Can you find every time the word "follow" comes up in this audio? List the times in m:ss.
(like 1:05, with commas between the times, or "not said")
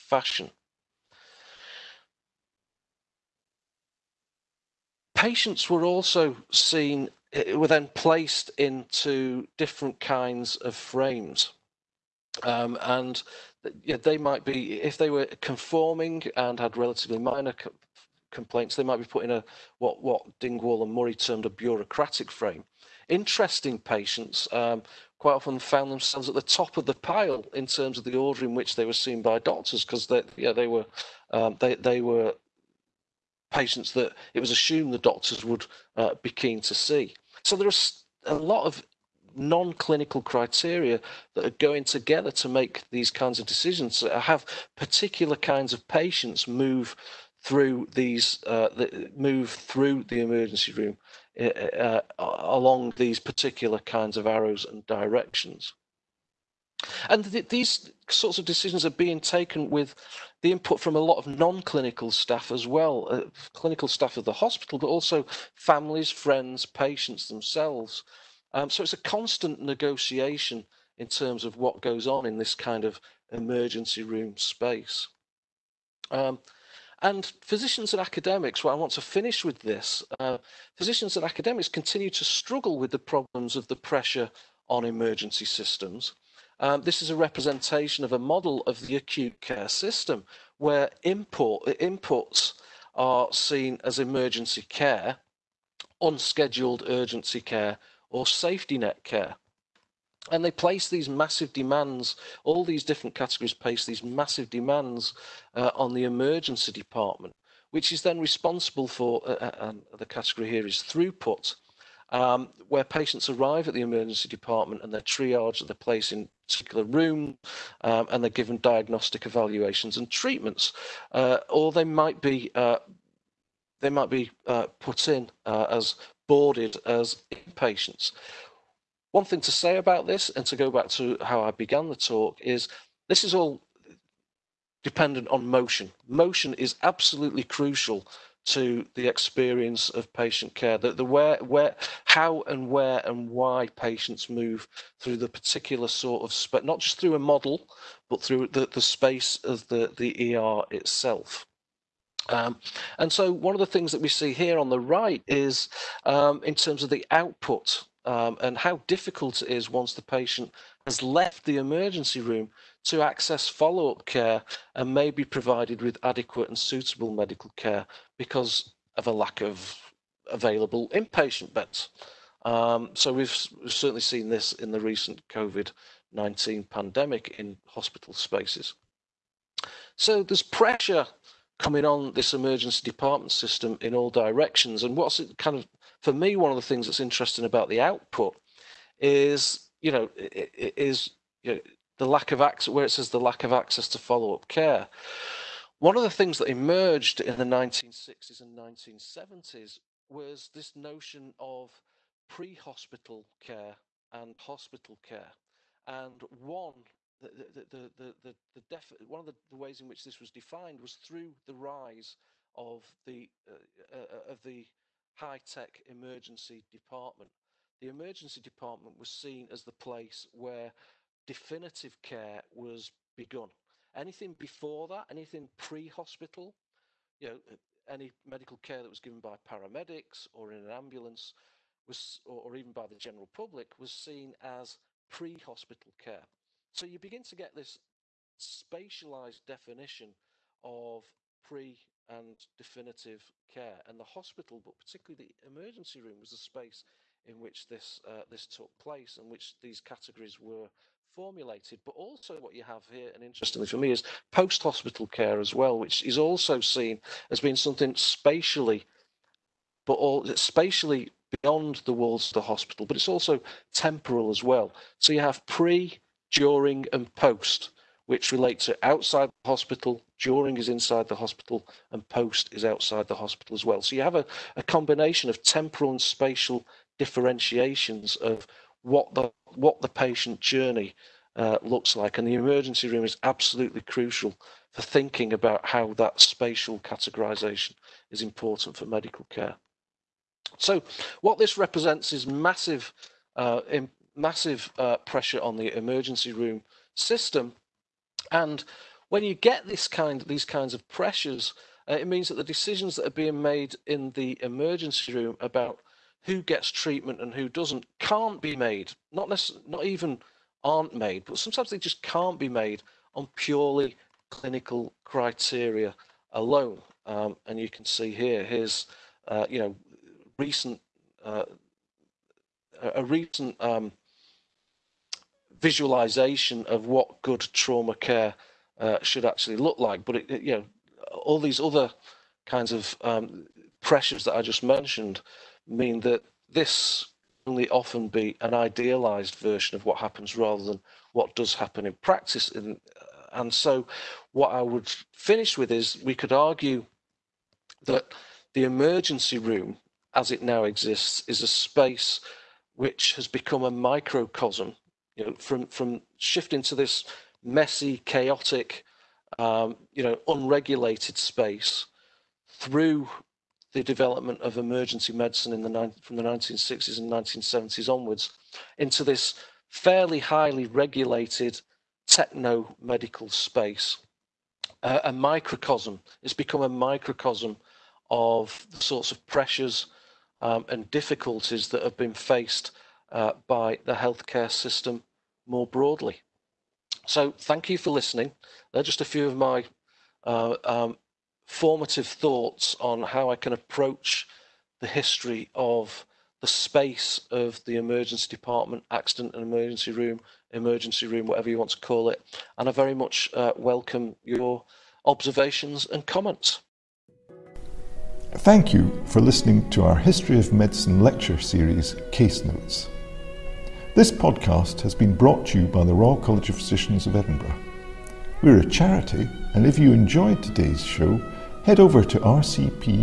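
2:43, 3:13.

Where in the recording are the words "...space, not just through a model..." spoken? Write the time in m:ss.
2:26.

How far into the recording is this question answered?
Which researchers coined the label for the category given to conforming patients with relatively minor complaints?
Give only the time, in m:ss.
0:20.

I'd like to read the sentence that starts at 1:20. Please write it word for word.
Uh, physicians and academics continue to struggle with the problems of the pressure on emergency systems.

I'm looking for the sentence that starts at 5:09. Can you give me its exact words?
Not not even aren't made, but sometimes they just can't be made on purely clinical criteria alone.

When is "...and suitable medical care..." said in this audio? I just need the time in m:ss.
2:46.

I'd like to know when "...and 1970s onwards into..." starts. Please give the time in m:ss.
6:06.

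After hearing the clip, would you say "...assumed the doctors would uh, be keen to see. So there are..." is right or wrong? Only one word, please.
right.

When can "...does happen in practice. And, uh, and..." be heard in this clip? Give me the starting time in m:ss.
5:41.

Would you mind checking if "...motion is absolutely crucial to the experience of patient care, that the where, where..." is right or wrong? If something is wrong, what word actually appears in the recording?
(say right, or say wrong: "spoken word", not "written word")
right.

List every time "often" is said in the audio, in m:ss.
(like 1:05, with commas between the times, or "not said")
0:25, 5:37.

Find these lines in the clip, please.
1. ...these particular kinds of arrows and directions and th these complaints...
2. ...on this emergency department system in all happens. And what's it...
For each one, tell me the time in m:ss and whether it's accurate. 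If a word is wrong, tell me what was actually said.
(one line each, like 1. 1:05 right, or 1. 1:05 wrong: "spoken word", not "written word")
1. 0:52 wrong: "sorts", not "complaints"
2. 3:01 wrong: "directions", not "happens".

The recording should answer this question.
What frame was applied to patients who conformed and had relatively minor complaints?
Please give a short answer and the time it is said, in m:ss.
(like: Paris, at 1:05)
Bureaucratic frame, at 0:21.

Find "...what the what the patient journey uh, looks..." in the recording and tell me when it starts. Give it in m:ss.
4:38.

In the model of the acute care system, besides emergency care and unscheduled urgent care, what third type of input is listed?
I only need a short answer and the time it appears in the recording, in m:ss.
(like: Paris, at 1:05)
Safety net care, at 1:38.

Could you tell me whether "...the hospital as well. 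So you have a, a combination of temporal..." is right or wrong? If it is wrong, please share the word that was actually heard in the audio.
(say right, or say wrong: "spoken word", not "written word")
right.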